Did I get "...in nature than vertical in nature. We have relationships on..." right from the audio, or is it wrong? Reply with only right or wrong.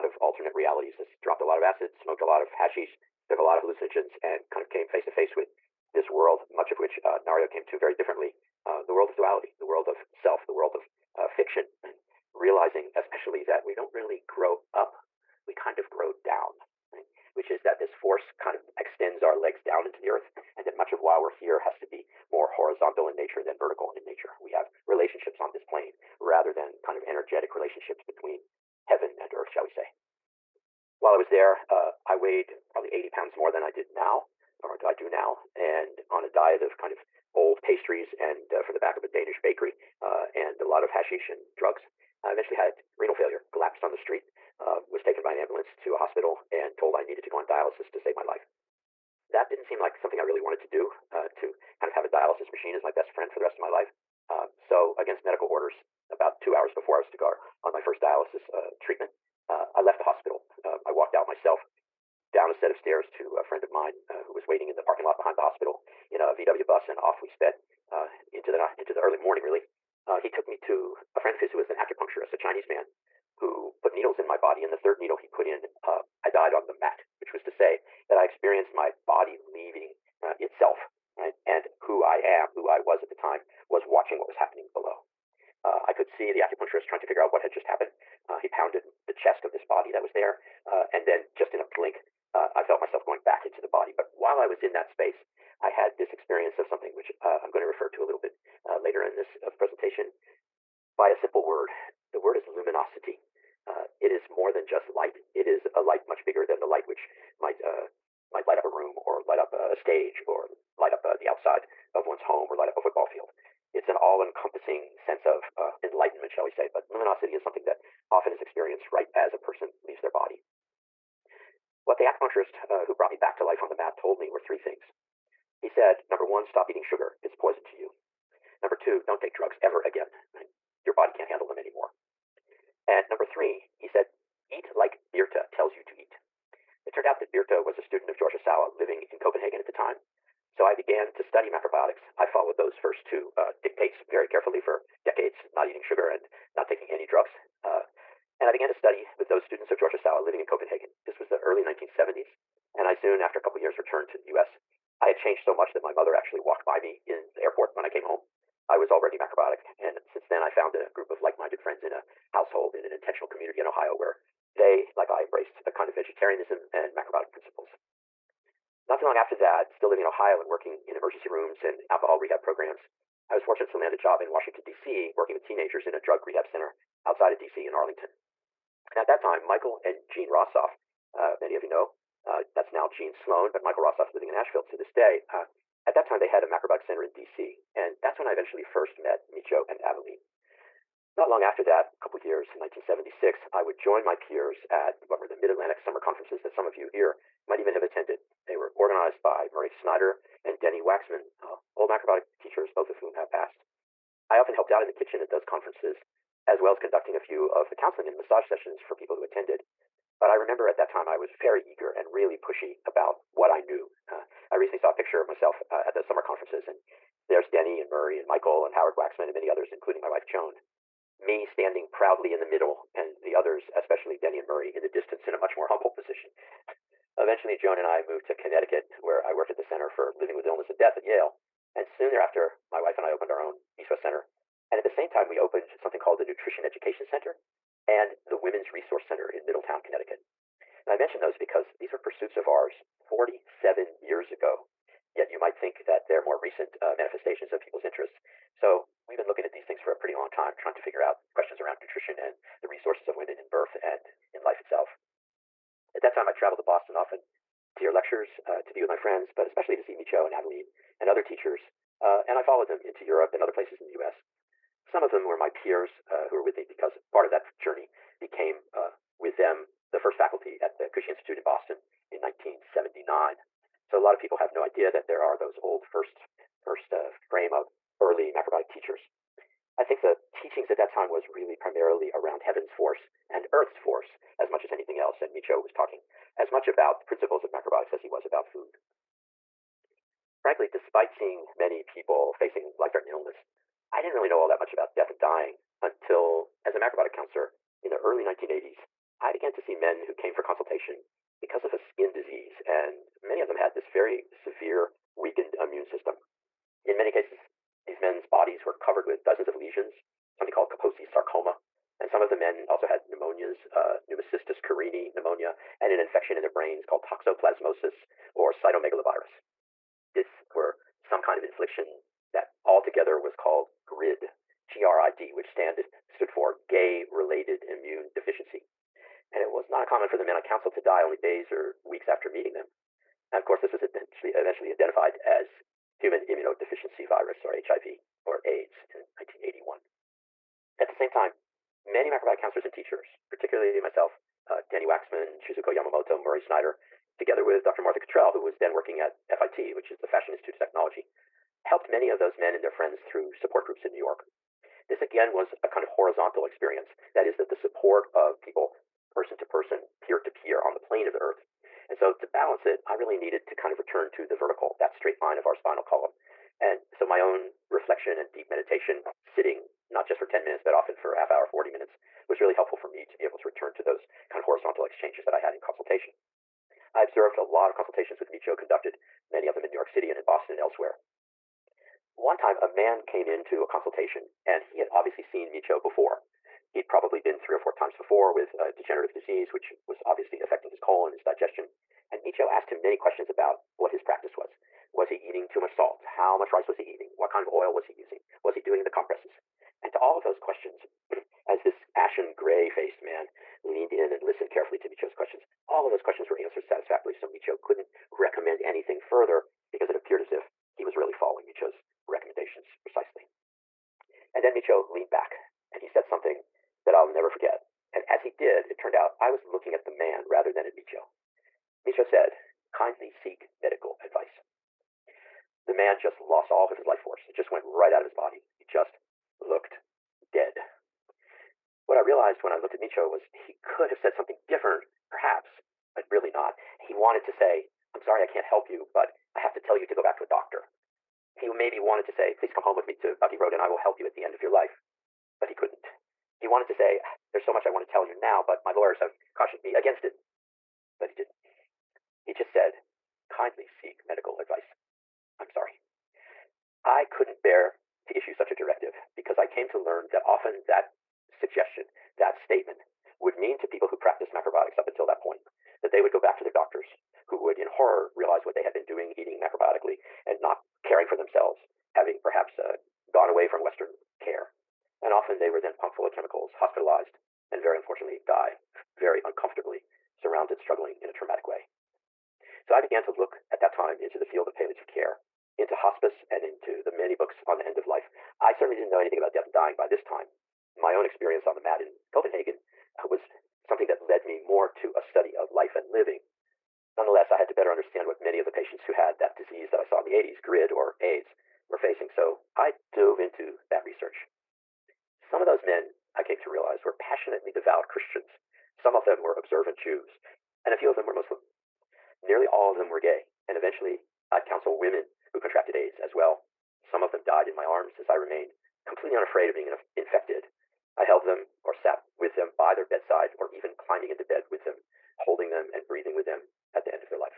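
right.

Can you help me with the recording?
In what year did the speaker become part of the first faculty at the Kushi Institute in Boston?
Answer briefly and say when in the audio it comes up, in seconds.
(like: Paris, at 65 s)
1979, at 272 s.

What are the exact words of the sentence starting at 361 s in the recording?
And so to balance it, I really needed to kind of return to the vertical, that straight line of our spinal column.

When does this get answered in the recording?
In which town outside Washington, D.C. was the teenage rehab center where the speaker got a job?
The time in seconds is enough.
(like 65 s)
177 s.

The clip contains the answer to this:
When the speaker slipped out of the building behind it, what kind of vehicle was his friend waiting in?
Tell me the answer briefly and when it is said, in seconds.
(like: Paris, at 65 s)
VW bus, at 66 s.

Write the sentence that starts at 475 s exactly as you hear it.
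And often they were then pumped full of chemicals, hospitalized, and very unfortunately die very uncomfortably, surrounded, struggling in a traumatic way.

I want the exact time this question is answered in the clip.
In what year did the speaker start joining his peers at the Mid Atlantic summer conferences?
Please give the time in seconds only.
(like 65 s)
192 s.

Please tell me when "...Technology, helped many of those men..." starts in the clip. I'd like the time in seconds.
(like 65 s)
350 s.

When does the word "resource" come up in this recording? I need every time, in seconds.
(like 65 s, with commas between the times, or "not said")
238 s, 252 s.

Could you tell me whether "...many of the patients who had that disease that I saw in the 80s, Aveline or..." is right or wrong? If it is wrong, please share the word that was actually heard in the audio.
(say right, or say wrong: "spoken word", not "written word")
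wrong: "GRID", not "Aveline".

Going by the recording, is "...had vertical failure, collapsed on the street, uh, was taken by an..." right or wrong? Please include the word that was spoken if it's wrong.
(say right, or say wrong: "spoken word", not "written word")
wrong: "renal", not "vertical".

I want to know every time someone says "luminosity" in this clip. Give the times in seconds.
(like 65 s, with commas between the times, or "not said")
102 s, 116 s.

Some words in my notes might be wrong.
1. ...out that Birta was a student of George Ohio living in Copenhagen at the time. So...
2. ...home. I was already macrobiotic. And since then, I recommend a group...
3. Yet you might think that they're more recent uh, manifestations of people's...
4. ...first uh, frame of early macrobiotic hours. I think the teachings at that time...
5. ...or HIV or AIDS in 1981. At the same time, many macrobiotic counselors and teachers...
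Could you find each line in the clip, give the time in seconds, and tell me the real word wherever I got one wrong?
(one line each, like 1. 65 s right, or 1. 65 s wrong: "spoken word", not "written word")
1. 137 s wrong: "Ohsawa", not "Ohio"
2. 158 s wrong: "found", not "recommend"
3. 245 s right
4. 276 s wrong: "teachers", not "hours"
5. 337 s right.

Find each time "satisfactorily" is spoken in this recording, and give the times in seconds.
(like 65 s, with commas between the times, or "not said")
406 s.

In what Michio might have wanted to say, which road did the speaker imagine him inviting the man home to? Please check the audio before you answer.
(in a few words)
Bucky Road.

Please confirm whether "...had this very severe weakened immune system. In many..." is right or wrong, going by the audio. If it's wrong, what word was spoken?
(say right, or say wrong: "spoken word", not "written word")
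right.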